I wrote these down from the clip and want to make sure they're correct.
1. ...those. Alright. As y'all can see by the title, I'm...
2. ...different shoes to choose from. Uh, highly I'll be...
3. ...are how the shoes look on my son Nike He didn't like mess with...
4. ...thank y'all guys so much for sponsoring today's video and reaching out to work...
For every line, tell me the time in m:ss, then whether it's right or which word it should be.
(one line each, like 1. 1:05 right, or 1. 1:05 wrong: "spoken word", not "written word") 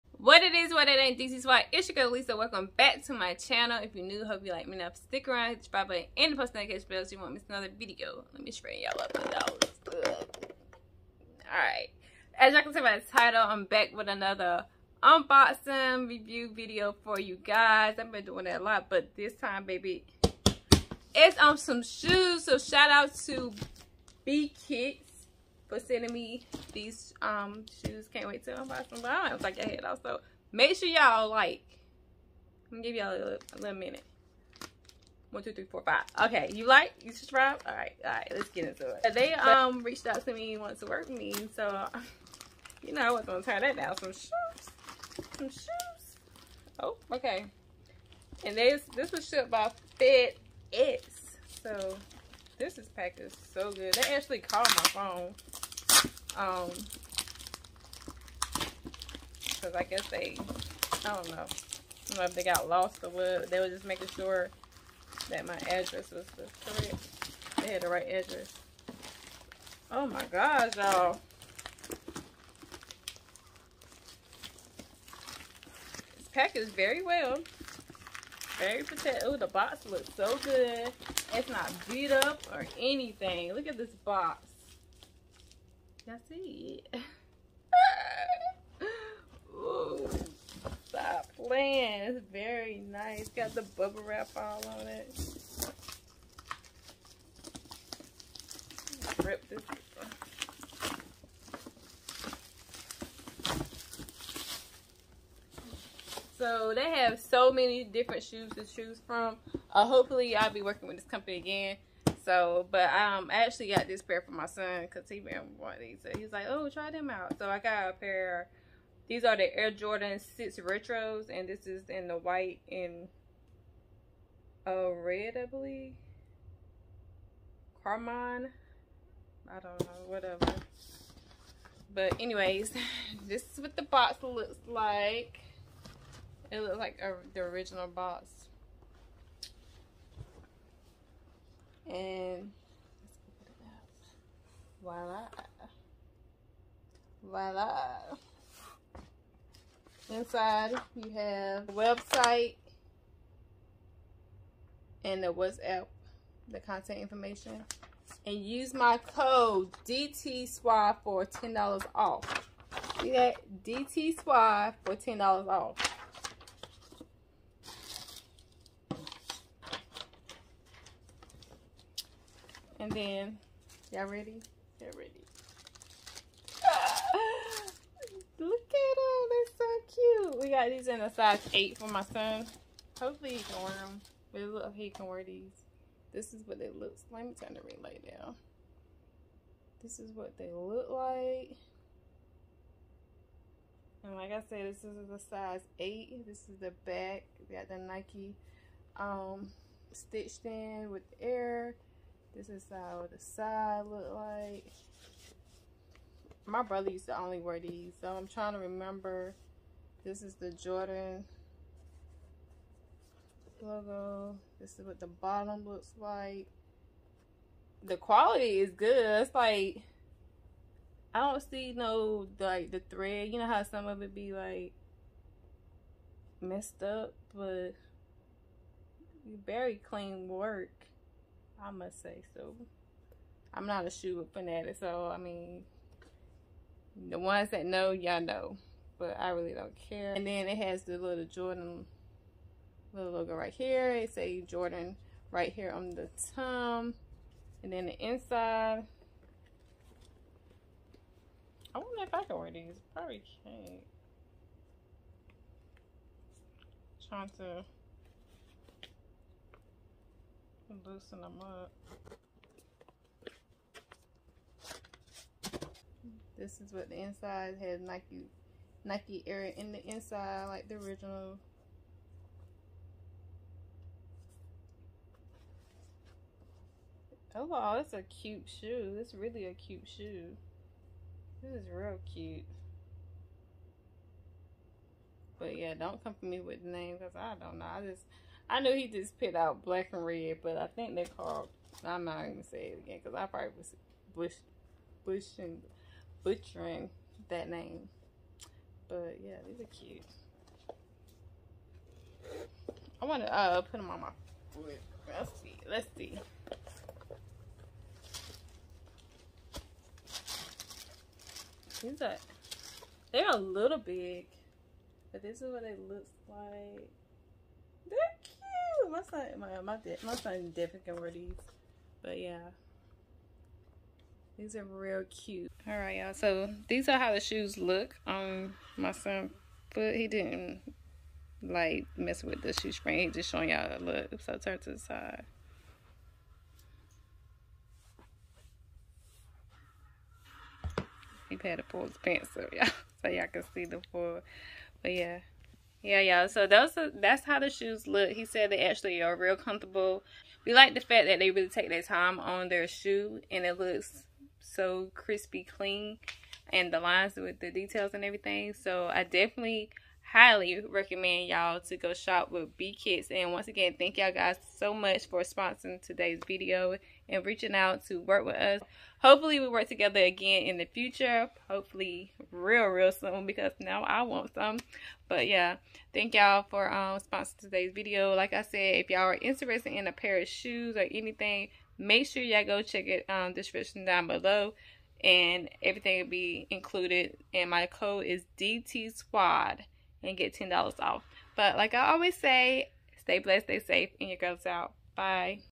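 1. 0:09 right
2. 1:47 wrong: "hopefully", not "highly"
3. 5:26 wrong: "But", not "Nike"
4. 6:03 right.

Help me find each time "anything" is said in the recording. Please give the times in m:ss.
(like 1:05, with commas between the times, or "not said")
1:22, 6:20.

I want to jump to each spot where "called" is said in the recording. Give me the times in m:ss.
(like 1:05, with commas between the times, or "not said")
0:54, 4:51.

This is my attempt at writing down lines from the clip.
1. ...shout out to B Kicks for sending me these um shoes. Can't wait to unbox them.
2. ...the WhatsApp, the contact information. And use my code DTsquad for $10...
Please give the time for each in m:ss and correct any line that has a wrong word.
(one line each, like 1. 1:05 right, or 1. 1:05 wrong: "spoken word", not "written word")
1. 0:22 right
2. 2:35 right.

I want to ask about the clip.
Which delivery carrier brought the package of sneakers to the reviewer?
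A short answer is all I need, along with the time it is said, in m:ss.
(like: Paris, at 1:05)
FedEx, at 0:50.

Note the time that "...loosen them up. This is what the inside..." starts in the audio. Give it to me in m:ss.
4:20.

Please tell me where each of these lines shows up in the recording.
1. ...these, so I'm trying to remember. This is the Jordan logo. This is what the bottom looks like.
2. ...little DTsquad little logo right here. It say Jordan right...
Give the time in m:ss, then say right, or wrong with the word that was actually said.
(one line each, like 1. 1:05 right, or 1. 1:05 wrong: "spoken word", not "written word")
1. 3:27 right
2. 4:00 wrong: "Jordan", not "DTsquad".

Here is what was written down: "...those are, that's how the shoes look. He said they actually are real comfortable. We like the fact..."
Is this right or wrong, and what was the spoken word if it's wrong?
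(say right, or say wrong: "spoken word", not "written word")
right.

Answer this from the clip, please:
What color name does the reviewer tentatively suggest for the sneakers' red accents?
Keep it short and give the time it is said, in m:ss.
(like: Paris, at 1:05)
Carmine, at 2:07.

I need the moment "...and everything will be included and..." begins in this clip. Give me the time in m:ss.
6:25.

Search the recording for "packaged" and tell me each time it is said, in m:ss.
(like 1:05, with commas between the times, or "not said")
0:52, 1:16.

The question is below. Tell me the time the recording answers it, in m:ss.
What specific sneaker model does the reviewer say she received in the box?
1:59.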